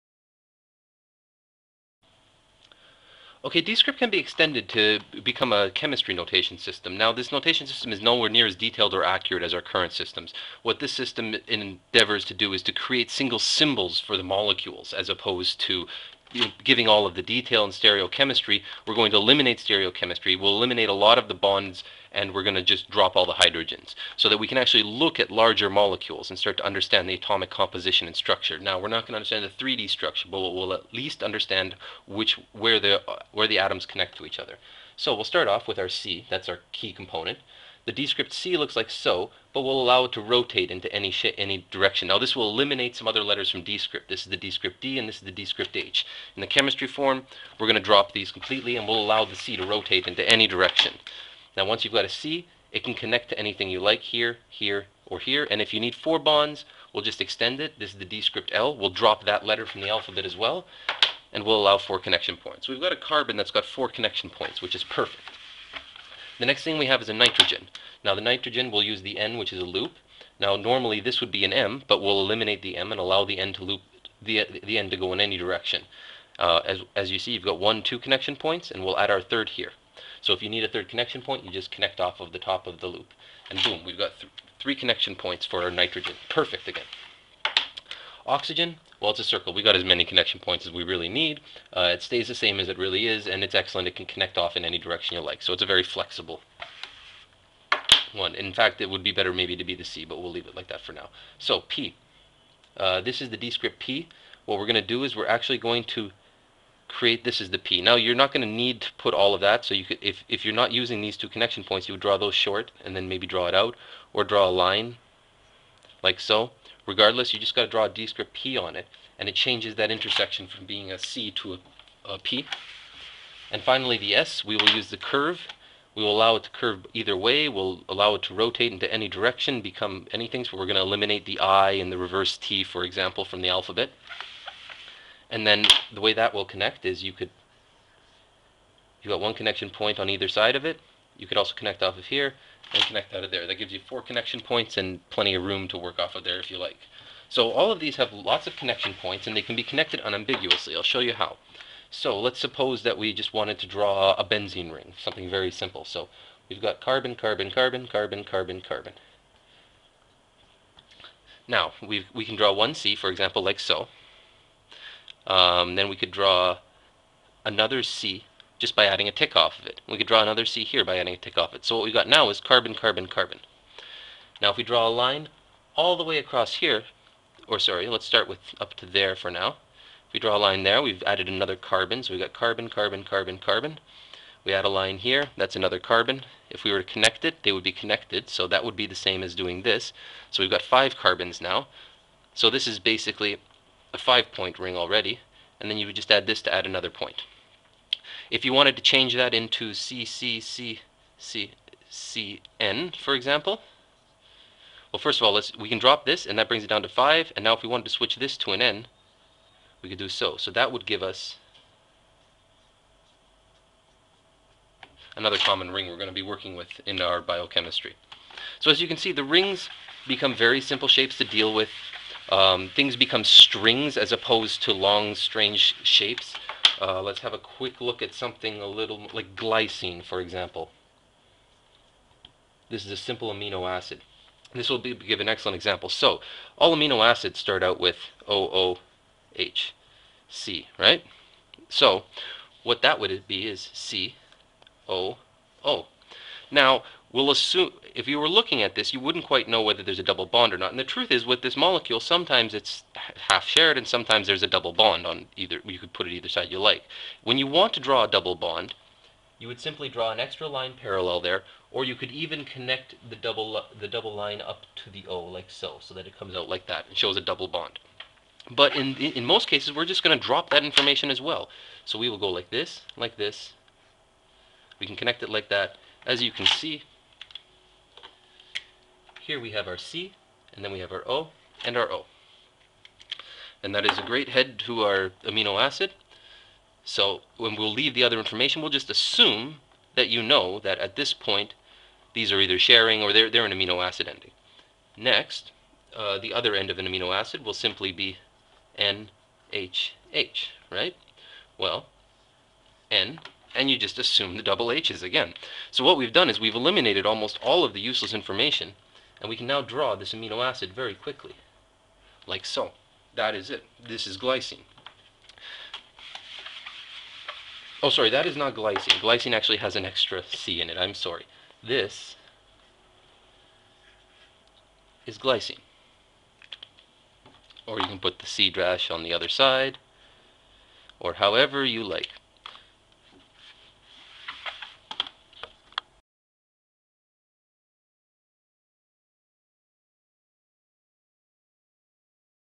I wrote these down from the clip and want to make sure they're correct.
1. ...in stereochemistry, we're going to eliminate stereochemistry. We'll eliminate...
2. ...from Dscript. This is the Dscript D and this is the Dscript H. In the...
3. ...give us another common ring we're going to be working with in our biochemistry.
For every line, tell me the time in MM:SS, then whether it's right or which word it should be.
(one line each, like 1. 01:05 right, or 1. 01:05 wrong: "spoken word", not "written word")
1. 00:17 right
2. 00:43 right
3. 03:30 right.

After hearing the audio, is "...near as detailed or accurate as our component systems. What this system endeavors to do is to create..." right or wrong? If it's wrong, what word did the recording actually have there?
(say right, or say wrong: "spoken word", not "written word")
wrong: "current", not "component".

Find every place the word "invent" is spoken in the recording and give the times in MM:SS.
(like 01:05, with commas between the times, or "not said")
not said.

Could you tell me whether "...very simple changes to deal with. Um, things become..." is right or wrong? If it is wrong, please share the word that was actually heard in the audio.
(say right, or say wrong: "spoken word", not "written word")
wrong: "shapes", not "changes".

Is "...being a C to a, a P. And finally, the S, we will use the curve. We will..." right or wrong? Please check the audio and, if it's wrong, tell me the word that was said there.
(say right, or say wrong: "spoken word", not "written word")
right.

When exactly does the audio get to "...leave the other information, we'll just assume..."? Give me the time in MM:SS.
04:47.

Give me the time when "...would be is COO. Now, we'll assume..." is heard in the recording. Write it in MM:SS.
04:02.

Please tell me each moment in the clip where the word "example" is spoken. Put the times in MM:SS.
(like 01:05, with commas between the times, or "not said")
02:12, 02:43, 03:23, 03:50, 03:55.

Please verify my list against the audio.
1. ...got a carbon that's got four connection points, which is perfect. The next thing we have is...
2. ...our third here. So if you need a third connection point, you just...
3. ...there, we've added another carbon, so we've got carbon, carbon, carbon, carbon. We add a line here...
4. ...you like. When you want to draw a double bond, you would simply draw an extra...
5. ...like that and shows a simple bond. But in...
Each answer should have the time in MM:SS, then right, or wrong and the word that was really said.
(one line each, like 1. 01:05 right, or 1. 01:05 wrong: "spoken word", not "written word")
1. 01:02 right
2. 01:19 right
3. 03:00 right
4. 04:16 right
5. 04:26 wrong: "double", not "simple".